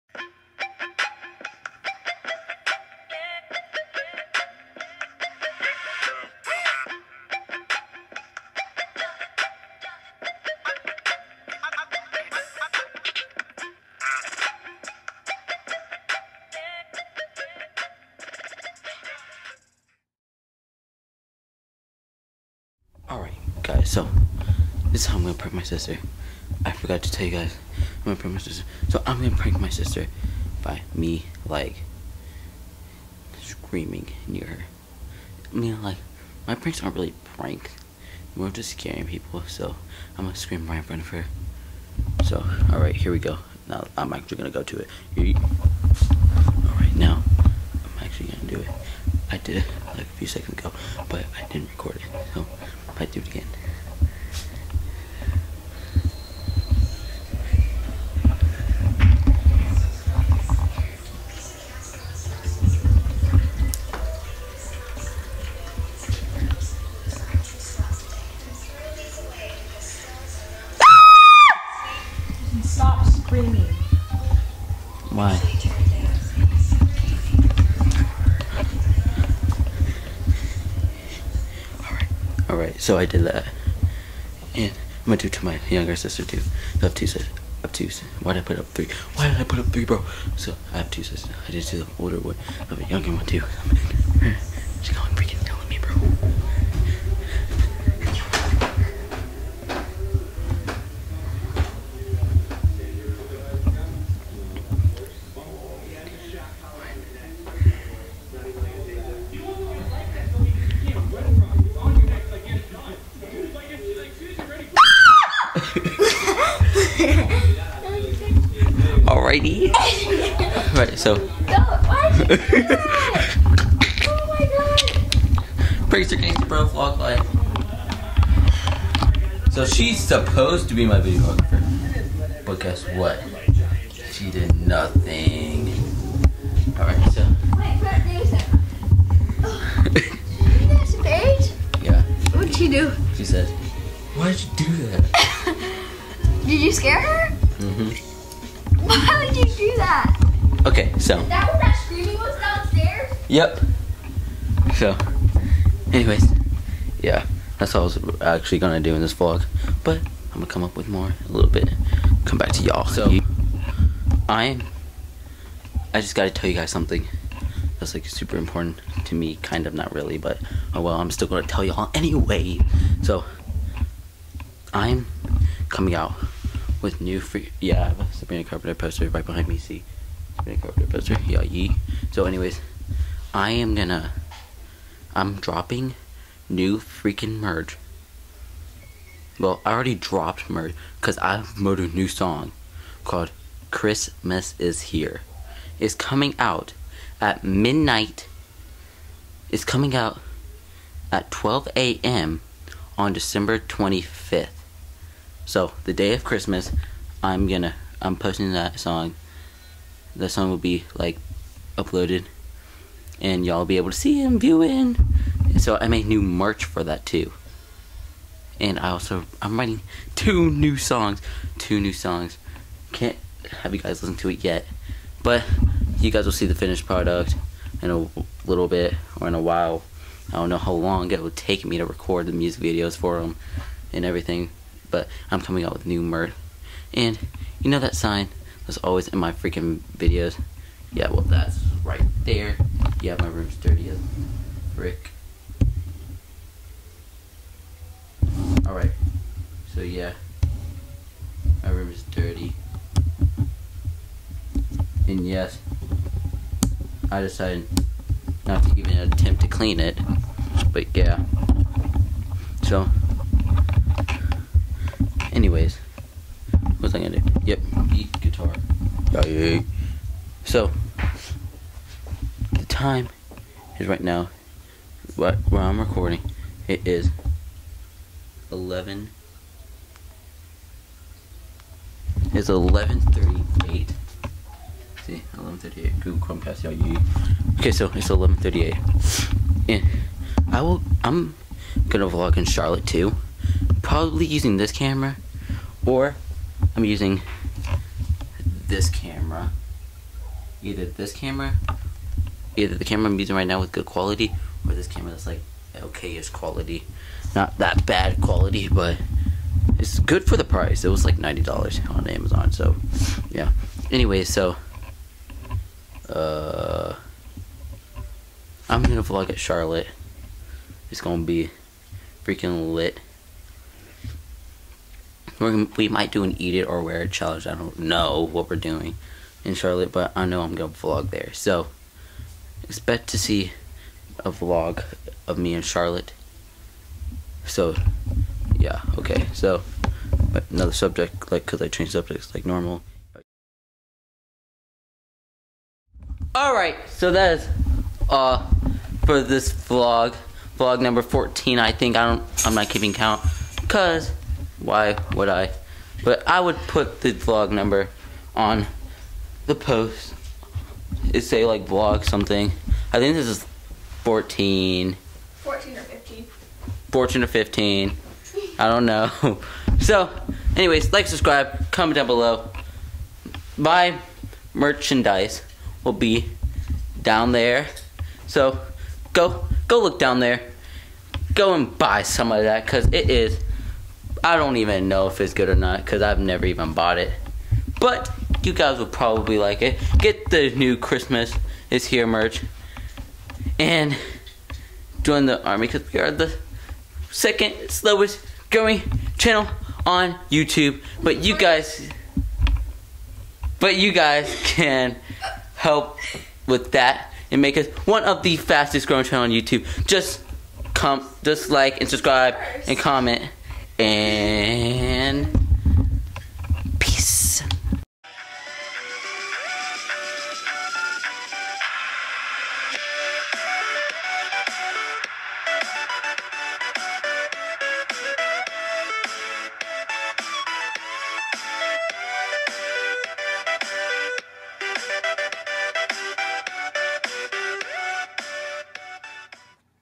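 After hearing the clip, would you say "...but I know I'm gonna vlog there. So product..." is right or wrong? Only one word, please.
wrong.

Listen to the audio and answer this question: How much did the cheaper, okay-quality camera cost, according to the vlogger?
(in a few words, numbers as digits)
$90.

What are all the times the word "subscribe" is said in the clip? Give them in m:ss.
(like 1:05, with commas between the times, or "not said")
6:11, 6:51.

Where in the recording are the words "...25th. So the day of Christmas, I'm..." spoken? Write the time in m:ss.
3:23.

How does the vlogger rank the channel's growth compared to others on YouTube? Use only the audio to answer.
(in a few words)
Second slowest growing.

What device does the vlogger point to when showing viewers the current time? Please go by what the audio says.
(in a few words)
Google Chromecast.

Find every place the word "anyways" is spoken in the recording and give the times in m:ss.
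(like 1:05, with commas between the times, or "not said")
2:35, 2:51, 3:02, 4:25, 5:13, 6:10.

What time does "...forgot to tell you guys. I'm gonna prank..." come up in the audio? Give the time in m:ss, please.
0:26.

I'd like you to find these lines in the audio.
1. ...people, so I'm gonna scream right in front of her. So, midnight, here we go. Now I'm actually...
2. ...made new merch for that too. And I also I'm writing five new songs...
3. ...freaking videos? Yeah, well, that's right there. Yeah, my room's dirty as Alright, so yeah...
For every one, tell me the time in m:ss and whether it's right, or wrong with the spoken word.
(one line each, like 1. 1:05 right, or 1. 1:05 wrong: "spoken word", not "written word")
1. 0:39 wrong: "alright", not "midnight"
2. 3:35 wrong: "two", not "five"
3. 3:59 right.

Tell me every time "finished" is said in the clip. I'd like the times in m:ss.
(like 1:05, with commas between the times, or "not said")
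3:46.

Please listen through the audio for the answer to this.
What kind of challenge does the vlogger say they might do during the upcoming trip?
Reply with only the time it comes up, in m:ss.
5:26.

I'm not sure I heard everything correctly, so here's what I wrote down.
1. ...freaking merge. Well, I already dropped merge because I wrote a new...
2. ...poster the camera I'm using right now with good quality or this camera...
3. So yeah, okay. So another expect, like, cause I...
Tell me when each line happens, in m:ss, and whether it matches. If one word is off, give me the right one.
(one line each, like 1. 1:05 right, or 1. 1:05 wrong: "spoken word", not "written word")
1. 3:06 right
2. 5:02 wrong: "either", not "poster"
3. 5:37 wrong: "subject", not "expect".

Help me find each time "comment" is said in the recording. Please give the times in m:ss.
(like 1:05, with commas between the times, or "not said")
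6:11, 6:52.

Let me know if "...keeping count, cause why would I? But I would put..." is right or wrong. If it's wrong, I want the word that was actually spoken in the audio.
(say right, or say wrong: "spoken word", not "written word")
right.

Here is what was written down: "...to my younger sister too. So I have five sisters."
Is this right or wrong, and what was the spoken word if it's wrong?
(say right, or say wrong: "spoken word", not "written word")
wrong: "two", not "five".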